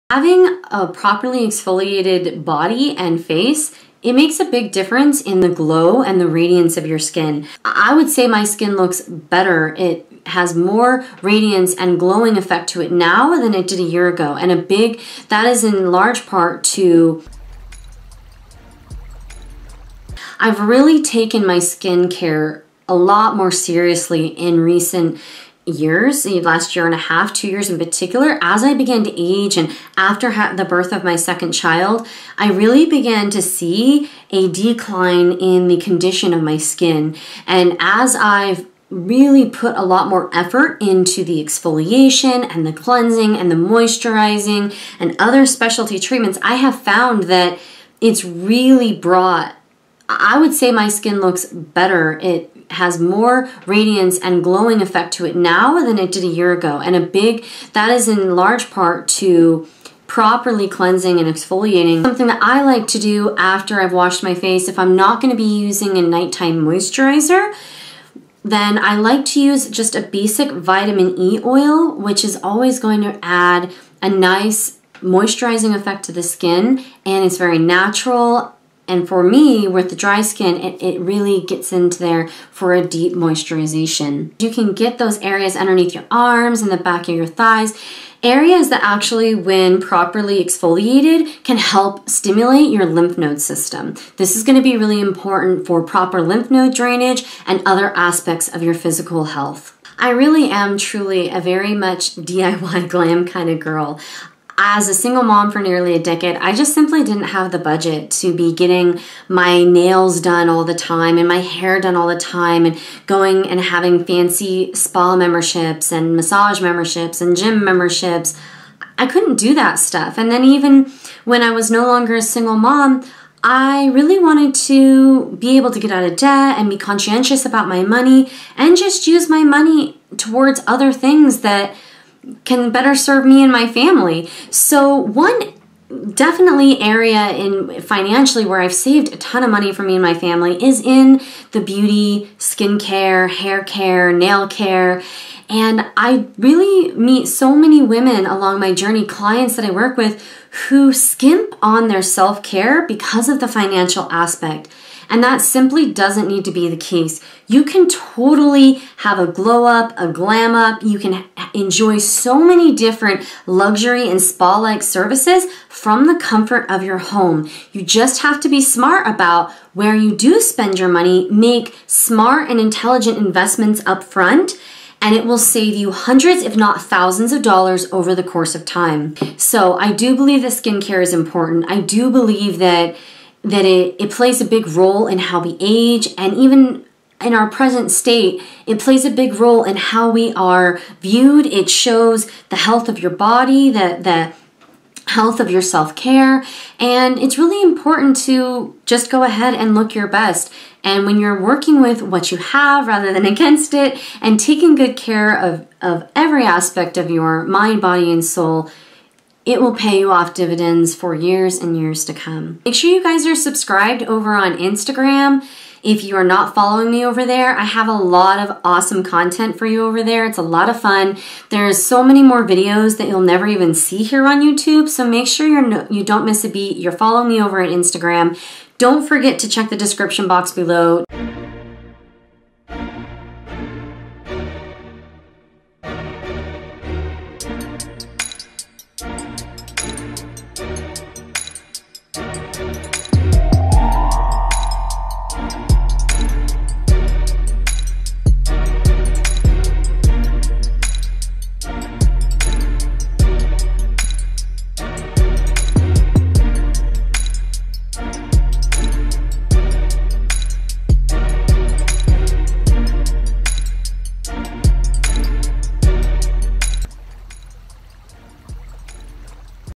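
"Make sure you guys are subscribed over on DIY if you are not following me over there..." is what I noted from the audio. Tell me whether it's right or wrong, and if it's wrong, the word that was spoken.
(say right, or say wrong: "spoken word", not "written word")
wrong: "Instagram", not "DIY".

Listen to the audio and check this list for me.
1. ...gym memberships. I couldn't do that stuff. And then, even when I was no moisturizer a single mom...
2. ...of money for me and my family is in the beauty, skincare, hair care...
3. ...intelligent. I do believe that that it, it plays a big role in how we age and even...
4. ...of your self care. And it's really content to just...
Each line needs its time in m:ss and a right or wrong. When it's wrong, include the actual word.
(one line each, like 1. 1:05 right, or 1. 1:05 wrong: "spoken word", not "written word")
1. 1:57 wrong: "longer", not "moisturizer"
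2. 2:19 right
3. 3:01 wrong: "important", not "intelligent"
4. 3:15 wrong: "important", not "content".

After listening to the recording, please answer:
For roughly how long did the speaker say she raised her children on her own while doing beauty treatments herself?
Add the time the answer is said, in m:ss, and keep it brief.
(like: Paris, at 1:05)
nearly a decade, at 1:45.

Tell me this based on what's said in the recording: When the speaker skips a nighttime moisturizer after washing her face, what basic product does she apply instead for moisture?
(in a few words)
vitamin E oil.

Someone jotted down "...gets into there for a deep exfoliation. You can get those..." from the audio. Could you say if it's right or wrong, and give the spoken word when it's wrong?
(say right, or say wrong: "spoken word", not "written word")
wrong: "moisturization", not "exfoliation".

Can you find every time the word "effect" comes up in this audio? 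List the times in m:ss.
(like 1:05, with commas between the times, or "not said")
0:12, 0:54, 1:15.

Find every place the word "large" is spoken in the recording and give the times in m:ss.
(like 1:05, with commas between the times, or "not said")
0:15, 0:58.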